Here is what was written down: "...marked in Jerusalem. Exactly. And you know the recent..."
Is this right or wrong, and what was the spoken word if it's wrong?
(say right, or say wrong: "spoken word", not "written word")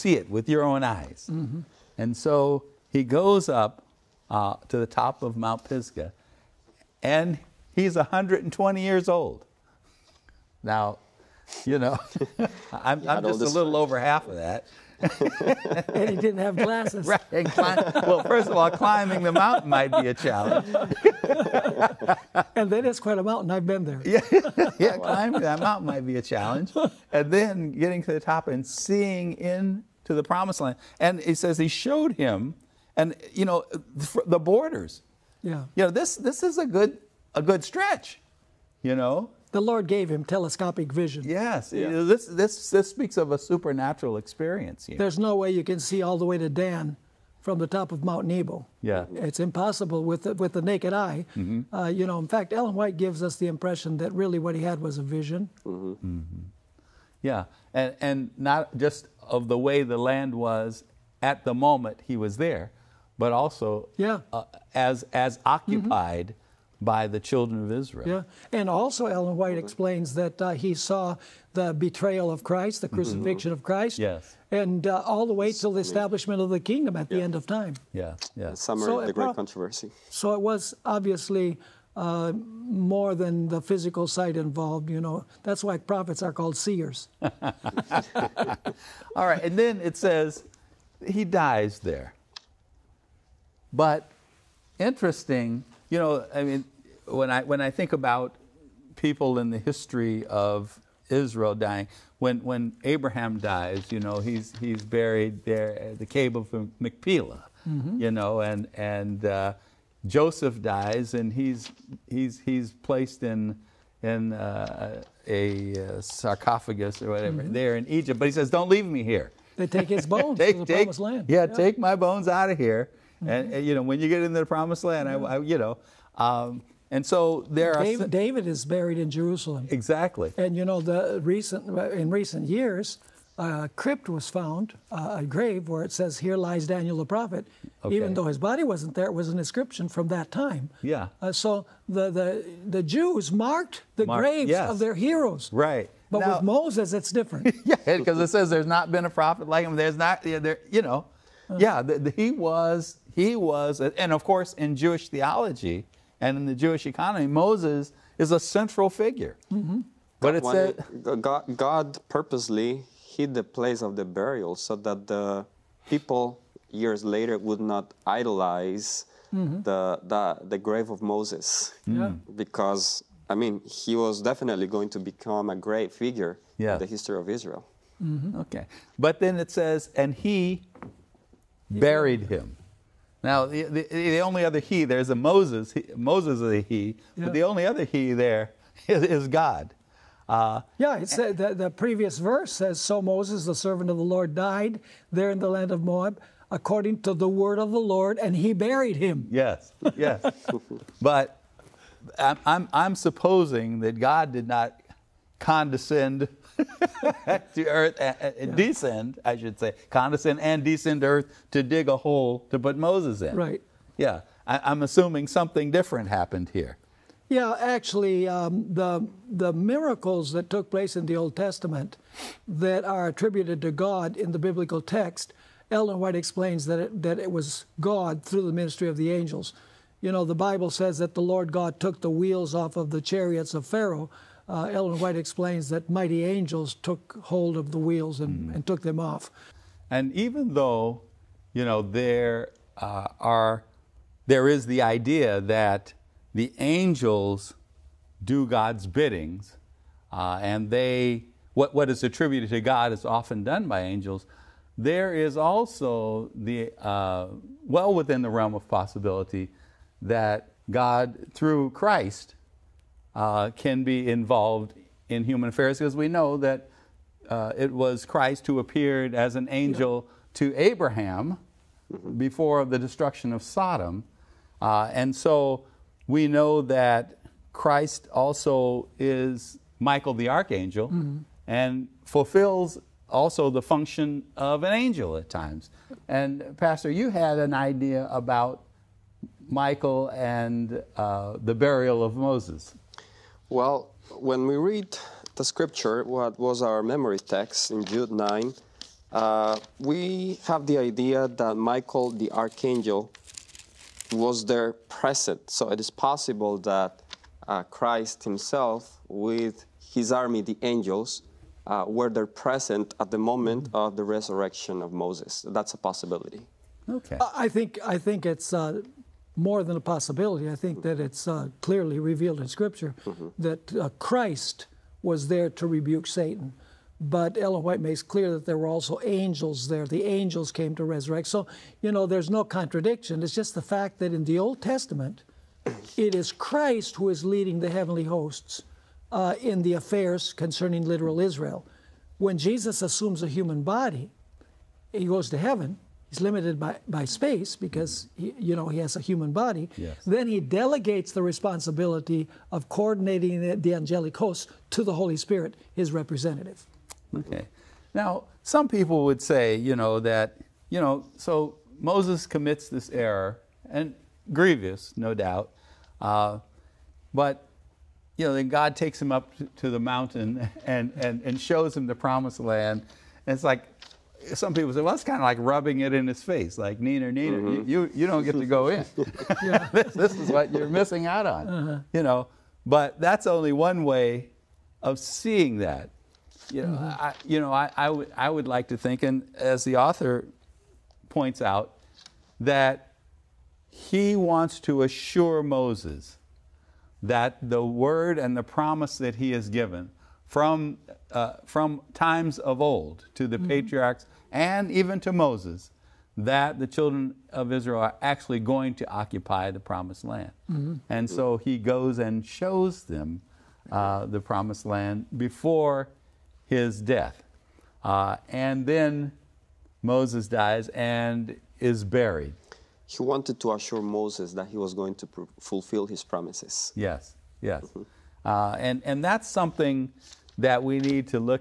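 wrong: "buried", not "marked".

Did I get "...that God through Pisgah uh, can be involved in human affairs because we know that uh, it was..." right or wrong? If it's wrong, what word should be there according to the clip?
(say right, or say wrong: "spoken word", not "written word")
wrong: "Christ", not "Pisgah".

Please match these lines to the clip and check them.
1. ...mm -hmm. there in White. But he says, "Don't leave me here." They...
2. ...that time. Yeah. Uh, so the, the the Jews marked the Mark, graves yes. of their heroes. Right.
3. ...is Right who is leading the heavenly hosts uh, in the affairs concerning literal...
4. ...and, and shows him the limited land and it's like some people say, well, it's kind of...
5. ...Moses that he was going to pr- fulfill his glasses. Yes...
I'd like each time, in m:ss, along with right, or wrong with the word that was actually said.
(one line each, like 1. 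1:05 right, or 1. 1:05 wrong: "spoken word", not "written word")
1. 1:57 wrong: "Egypt", not "White"
2. 2:20 right
3. 5:36 wrong: "Christ", not "Right"
4. 6:10 wrong: "promised", not "limited"
5. 7:03 wrong: "promises", not "glasses".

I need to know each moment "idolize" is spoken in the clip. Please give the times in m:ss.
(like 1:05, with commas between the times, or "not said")
2:48.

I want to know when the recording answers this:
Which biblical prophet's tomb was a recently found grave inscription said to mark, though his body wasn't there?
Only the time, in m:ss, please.
2:16.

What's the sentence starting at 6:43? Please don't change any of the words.
patriarchs and even to Moses that the children of Israel are actually going to occupy the promised land.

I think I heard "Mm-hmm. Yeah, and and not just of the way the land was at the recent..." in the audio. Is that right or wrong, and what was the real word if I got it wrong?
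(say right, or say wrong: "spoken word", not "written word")
wrong: "moment", not "recent".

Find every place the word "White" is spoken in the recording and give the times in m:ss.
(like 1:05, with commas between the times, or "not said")
0:52, 1:09, 3:45, 3:54, 5:27.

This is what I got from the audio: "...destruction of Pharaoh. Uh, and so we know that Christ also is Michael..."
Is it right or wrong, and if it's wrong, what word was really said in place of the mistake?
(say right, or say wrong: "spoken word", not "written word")
wrong: "Sodom", not "Pharaoh".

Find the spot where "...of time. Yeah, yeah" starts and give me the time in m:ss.
1:17.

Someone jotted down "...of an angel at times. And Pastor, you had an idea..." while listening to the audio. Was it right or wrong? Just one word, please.
right.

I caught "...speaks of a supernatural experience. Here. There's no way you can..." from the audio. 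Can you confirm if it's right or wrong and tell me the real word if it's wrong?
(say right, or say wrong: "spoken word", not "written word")
right.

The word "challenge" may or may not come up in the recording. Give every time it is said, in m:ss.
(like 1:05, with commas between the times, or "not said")
0:20, 0:26.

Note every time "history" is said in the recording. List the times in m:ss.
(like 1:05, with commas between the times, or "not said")
1:39, 2:56.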